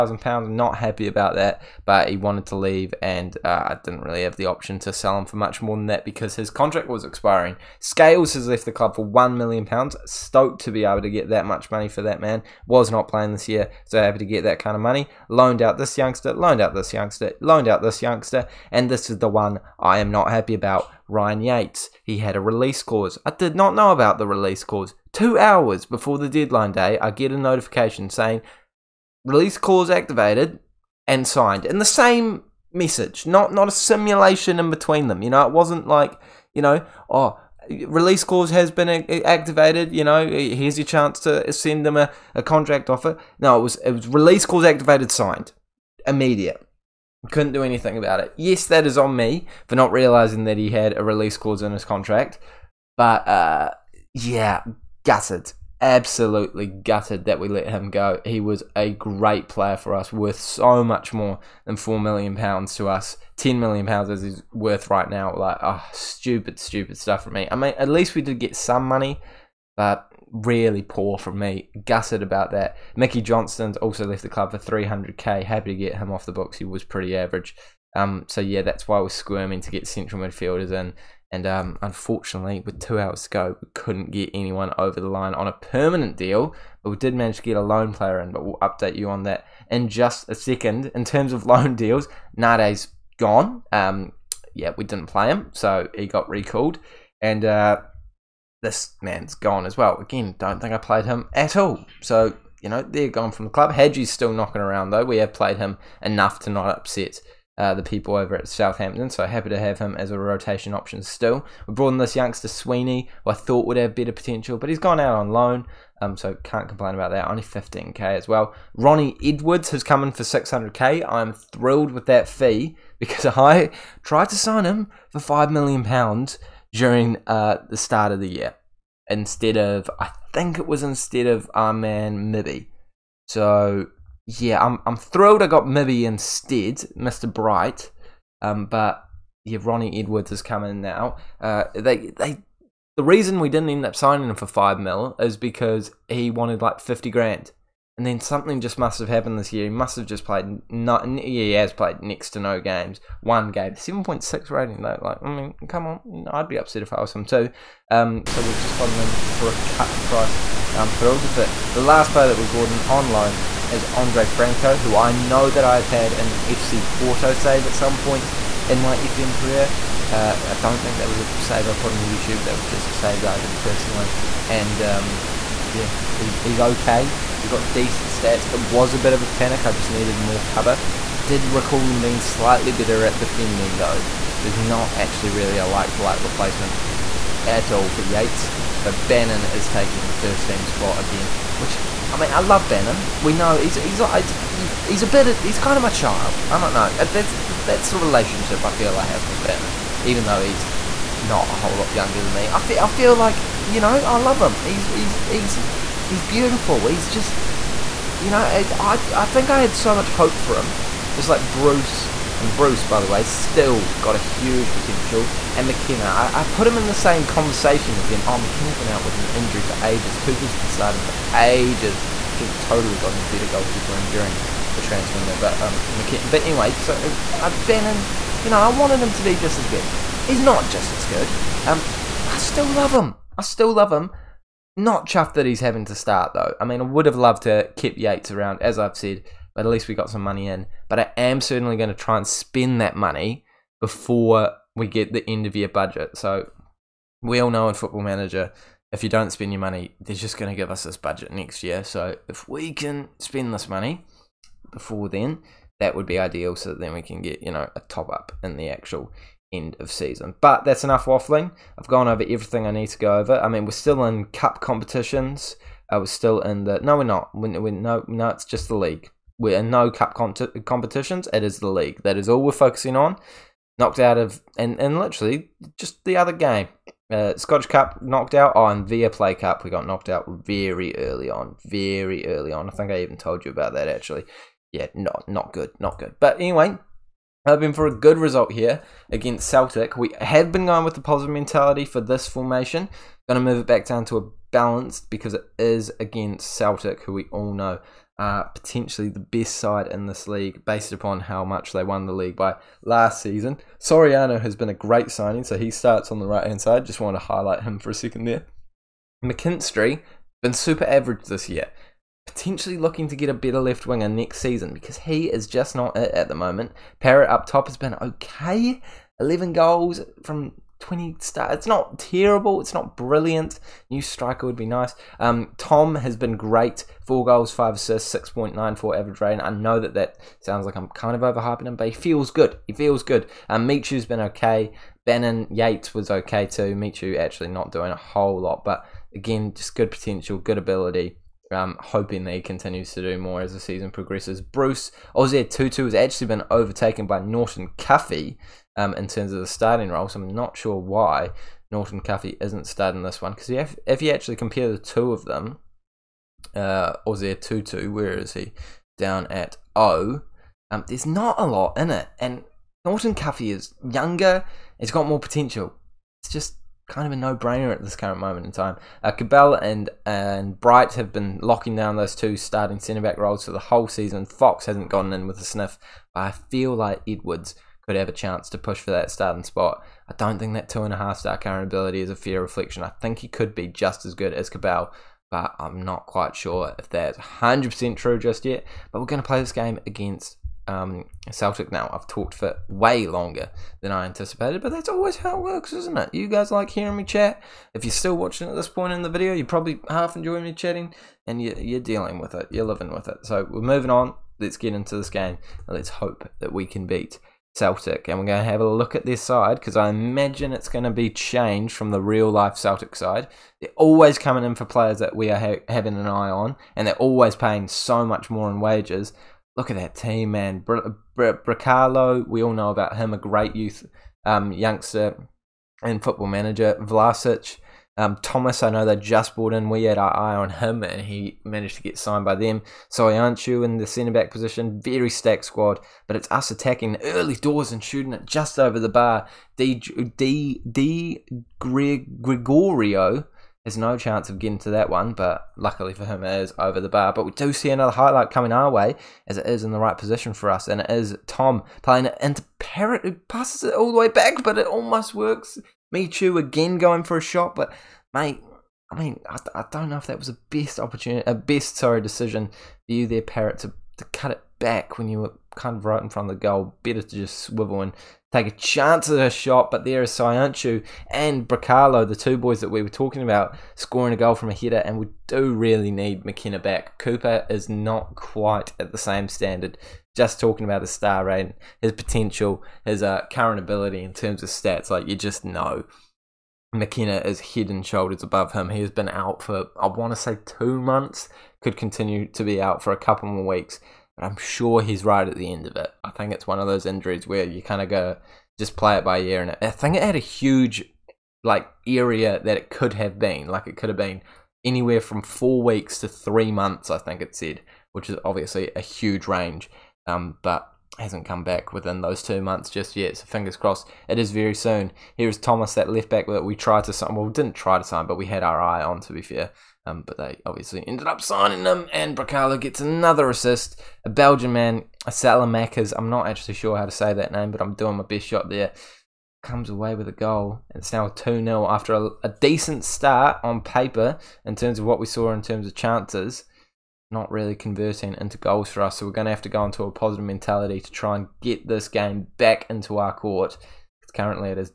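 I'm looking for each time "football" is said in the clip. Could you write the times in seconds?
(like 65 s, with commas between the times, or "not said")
247 s, 426 s.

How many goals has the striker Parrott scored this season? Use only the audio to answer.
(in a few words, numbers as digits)
11.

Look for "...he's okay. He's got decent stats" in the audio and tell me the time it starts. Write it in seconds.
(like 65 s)
176 s.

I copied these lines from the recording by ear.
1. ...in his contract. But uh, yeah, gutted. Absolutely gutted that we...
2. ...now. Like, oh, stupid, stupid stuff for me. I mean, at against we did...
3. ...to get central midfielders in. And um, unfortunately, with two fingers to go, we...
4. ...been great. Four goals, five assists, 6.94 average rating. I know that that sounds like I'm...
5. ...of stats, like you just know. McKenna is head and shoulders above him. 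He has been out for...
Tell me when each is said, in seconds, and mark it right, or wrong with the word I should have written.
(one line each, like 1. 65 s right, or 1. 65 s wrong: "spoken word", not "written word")
1. 51 s right
2. 65 s wrong: "least", not "against"
3. 79 s wrong: "hours", not "fingers"
4. 326 s right
5. 484 s right.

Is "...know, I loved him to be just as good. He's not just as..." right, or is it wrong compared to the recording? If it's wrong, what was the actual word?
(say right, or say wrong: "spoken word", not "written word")
wrong: "wanted", not "loved".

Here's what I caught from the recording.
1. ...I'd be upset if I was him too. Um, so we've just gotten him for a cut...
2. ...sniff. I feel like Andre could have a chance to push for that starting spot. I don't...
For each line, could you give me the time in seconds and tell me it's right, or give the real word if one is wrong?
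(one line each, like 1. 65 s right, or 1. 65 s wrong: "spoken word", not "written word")
1. 156 s right
2. 375 s wrong: "Edwards", not "Andre".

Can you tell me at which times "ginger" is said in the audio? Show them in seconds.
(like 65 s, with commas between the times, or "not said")
not said.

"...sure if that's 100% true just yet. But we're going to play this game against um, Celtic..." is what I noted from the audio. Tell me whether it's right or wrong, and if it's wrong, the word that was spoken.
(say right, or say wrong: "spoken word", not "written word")
right.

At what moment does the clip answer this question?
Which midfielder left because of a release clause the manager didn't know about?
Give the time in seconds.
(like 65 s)
21 s.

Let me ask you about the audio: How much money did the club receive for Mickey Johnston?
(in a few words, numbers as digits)
300k.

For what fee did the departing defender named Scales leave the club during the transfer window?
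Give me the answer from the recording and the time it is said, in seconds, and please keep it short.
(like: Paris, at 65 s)
£1 million, at 9 s.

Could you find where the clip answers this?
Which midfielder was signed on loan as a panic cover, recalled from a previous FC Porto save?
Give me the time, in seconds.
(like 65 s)
163 s.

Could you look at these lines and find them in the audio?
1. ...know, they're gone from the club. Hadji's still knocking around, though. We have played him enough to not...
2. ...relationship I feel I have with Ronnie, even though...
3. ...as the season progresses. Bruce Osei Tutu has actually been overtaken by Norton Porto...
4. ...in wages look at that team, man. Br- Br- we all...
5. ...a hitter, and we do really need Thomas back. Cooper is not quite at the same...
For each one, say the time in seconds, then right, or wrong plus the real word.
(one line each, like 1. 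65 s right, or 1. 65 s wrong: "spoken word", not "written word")
1. 102 s right
2. 197 s wrong: "Bannon", not "Ronnie"
3. 343 s wrong: "Cuffy", not "Porto"
4. 418 s right
5. 474 s wrong: "McKenna", not "Thomas".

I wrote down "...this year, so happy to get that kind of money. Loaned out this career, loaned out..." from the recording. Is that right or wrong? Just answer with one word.
wrong.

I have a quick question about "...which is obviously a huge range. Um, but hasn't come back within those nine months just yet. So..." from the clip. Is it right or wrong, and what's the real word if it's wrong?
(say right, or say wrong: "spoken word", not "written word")
wrong: "two", not "nine".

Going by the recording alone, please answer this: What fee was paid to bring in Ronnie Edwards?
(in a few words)
600k.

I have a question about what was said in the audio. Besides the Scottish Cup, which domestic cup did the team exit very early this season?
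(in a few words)
Viaplay Cup.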